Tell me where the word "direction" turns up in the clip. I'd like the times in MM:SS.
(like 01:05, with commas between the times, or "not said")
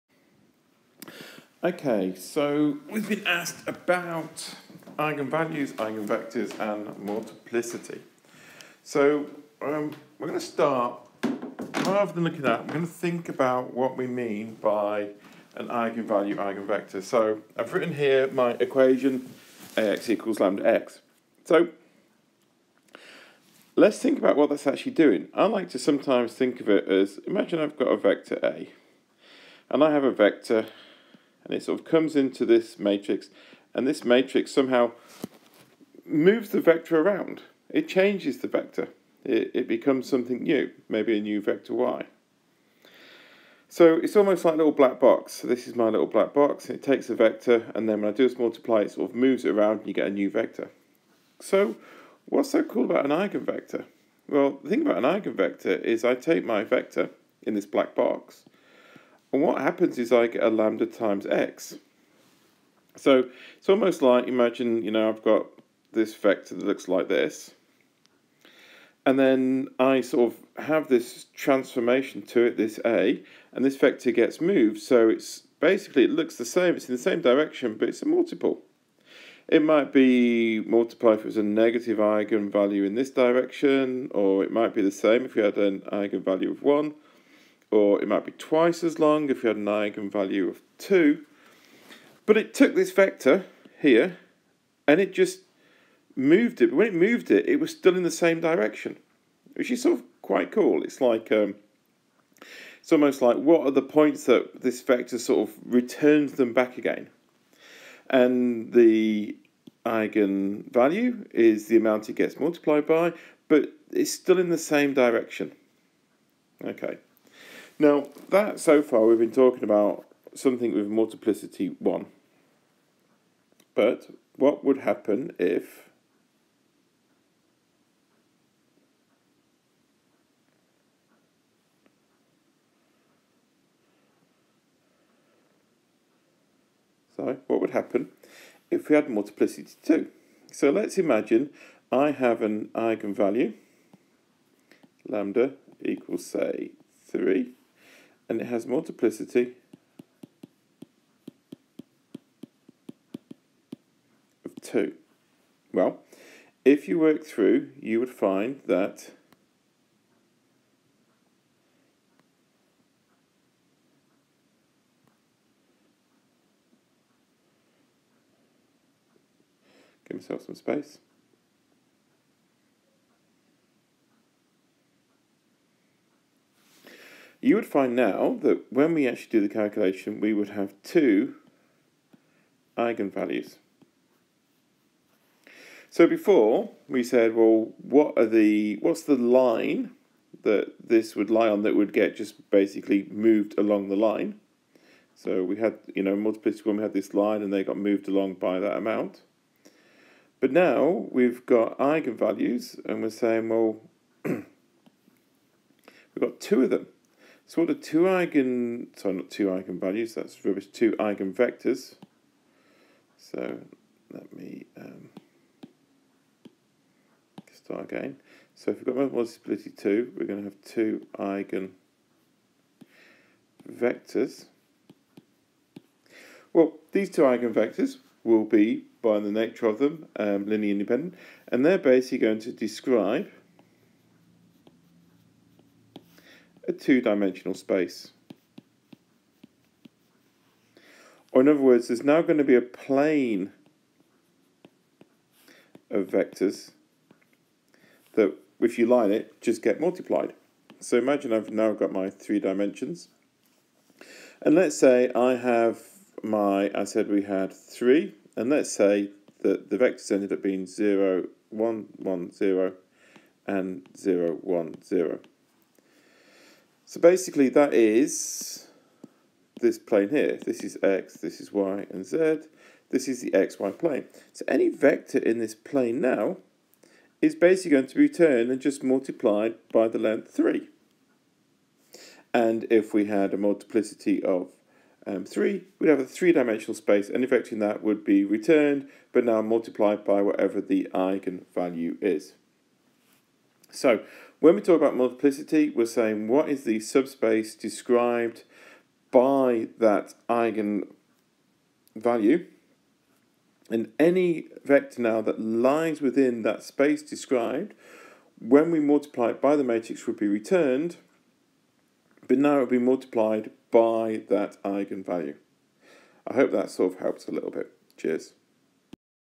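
01:17, 01:23, 01:38, 01:54.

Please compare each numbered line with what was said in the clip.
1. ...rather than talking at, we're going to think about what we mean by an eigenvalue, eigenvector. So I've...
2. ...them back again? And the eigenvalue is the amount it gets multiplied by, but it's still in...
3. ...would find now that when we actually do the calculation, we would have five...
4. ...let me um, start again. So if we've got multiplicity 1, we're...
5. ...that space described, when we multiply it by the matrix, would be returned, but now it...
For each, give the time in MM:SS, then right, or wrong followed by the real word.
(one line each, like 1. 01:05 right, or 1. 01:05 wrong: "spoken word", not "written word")
1. 00:11 wrong: "looking", not "talking"
2. 01:46 right
3. 02:57 wrong: "two", not "five"
4. 03:34 wrong: "2", not "1"
5. 05:06 right.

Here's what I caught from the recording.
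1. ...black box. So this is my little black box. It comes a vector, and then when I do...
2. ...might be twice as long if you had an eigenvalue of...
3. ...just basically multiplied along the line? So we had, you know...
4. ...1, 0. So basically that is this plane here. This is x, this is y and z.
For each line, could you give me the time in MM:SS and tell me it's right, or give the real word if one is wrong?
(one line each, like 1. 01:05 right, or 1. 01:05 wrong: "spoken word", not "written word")
1. 00:44 wrong: "takes", not "comes"
2. 01:28 right
3. 03:12 wrong: "moved", not "multiplied"
4. 04:24 right.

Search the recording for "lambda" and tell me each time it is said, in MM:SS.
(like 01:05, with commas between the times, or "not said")
00:20, 01:00, 02:25.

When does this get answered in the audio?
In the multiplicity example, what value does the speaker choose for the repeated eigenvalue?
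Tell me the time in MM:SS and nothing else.
02:25.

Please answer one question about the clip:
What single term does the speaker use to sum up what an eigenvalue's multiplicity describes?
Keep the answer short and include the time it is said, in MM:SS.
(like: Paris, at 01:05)
subspace, at 04:56.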